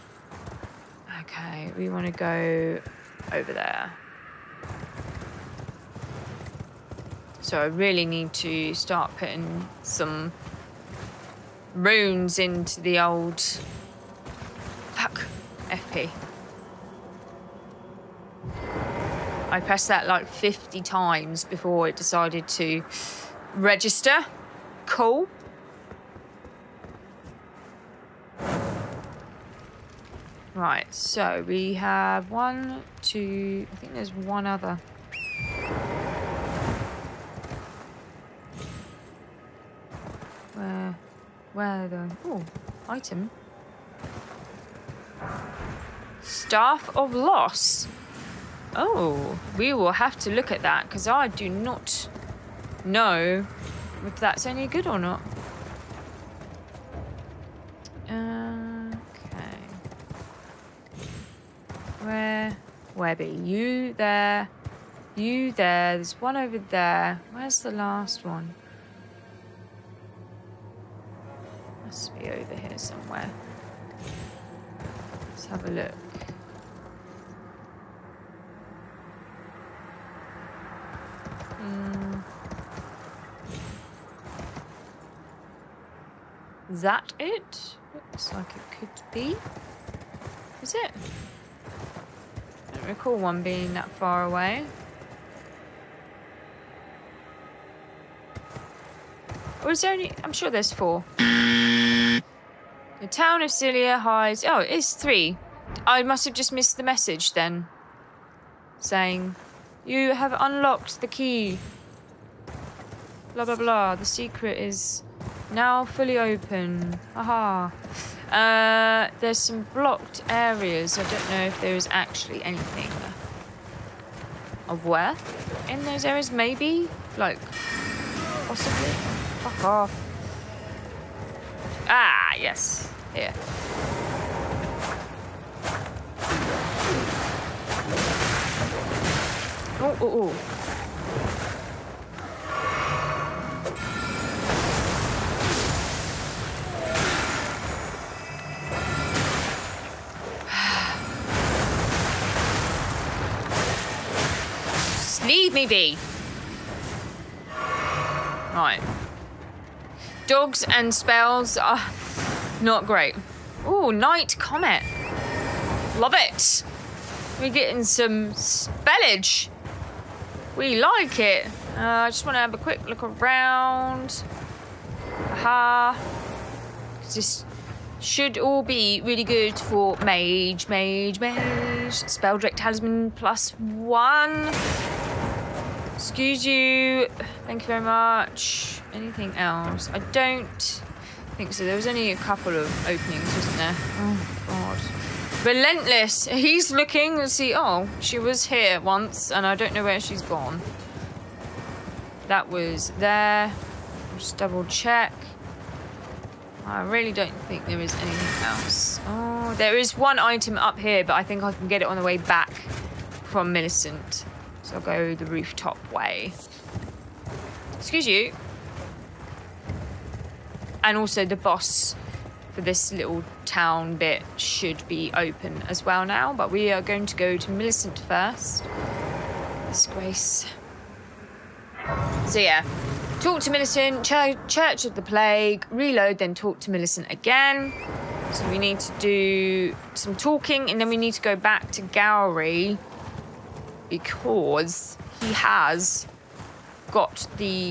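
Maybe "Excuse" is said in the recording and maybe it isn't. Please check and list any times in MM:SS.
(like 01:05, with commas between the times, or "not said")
03:05, 03:37.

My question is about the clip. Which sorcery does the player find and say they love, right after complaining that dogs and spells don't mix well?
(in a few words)
Night Comet.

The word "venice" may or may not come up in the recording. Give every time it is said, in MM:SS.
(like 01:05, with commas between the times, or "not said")
not said.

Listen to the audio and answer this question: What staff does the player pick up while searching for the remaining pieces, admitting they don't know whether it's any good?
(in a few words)
Staff of Loss.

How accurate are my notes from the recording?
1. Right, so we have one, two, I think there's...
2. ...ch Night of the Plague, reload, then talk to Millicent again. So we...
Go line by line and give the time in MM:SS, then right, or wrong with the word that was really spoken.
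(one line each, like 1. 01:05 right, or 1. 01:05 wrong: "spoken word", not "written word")
1. 00:30 right
2. 03:54 wrong: "Church", not "Night".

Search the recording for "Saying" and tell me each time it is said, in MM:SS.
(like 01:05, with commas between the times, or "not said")
01:48.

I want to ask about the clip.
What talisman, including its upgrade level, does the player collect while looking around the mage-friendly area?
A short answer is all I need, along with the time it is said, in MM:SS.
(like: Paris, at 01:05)
Spelldrake Talisman +1, at 03:02.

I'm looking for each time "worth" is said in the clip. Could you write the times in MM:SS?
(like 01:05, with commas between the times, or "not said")
02:04.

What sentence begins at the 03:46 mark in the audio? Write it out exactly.
But we are going to go to Millicent first.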